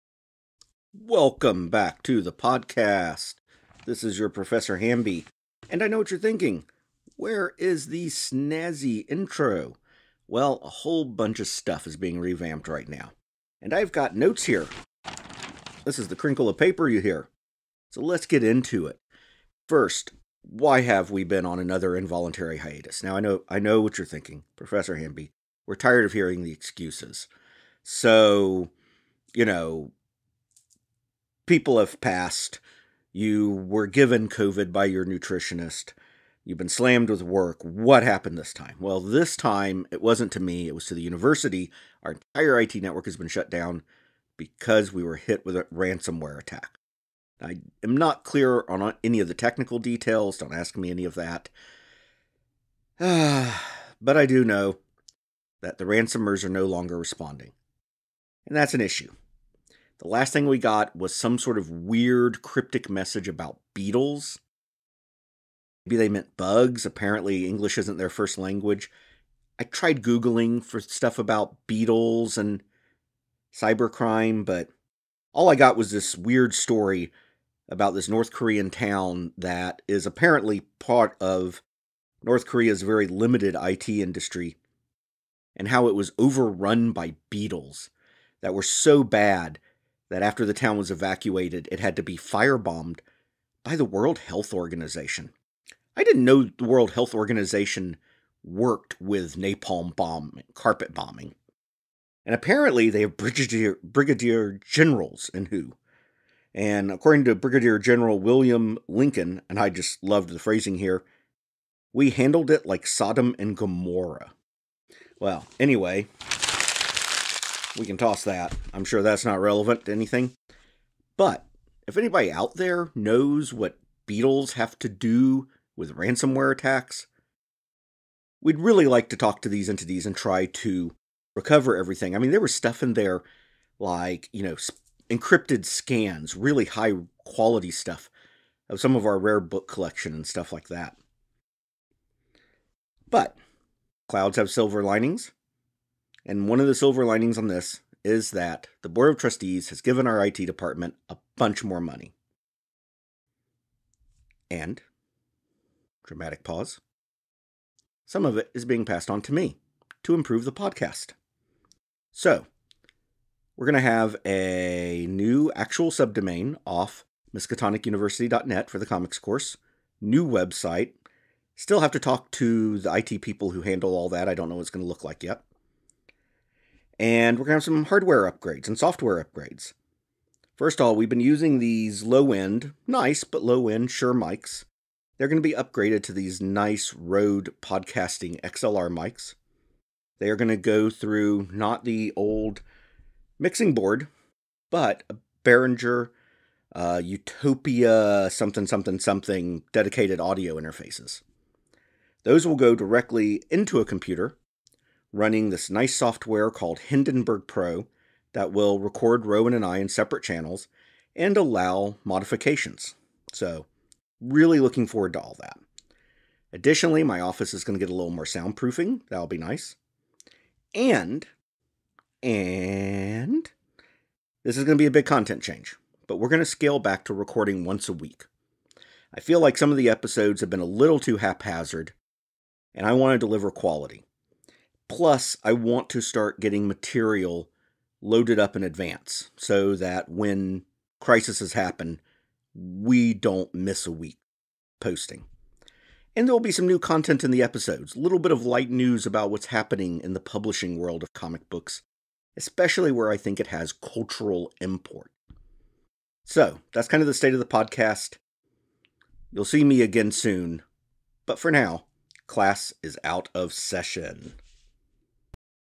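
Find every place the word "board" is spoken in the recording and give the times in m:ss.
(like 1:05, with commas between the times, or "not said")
2:28, 3:13.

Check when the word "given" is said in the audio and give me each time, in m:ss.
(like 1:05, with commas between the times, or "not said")
0:33, 2:29.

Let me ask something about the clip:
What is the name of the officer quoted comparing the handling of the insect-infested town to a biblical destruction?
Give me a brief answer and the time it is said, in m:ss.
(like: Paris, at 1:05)
William Lincoln, at 1:48.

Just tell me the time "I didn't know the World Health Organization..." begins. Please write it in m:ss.
1:35.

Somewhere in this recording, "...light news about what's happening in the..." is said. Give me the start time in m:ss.
4:08.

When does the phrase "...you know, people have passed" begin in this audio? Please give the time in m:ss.
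0:29.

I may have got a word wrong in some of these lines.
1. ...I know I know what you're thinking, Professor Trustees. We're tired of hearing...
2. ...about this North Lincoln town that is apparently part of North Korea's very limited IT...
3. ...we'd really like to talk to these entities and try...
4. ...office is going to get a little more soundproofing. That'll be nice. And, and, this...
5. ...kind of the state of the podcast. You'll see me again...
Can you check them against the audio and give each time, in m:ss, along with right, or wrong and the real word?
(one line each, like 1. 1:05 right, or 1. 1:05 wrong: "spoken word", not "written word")
1. 0:23 wrong: "Hamby", not "Trustees"
2. 1:17 wrong: "Korean", not "Lincoln"
3. 2:08 right
4. 3:37 right
5. 4:16 right.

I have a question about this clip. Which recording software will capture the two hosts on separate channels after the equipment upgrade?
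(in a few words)
Hindenburg Pro.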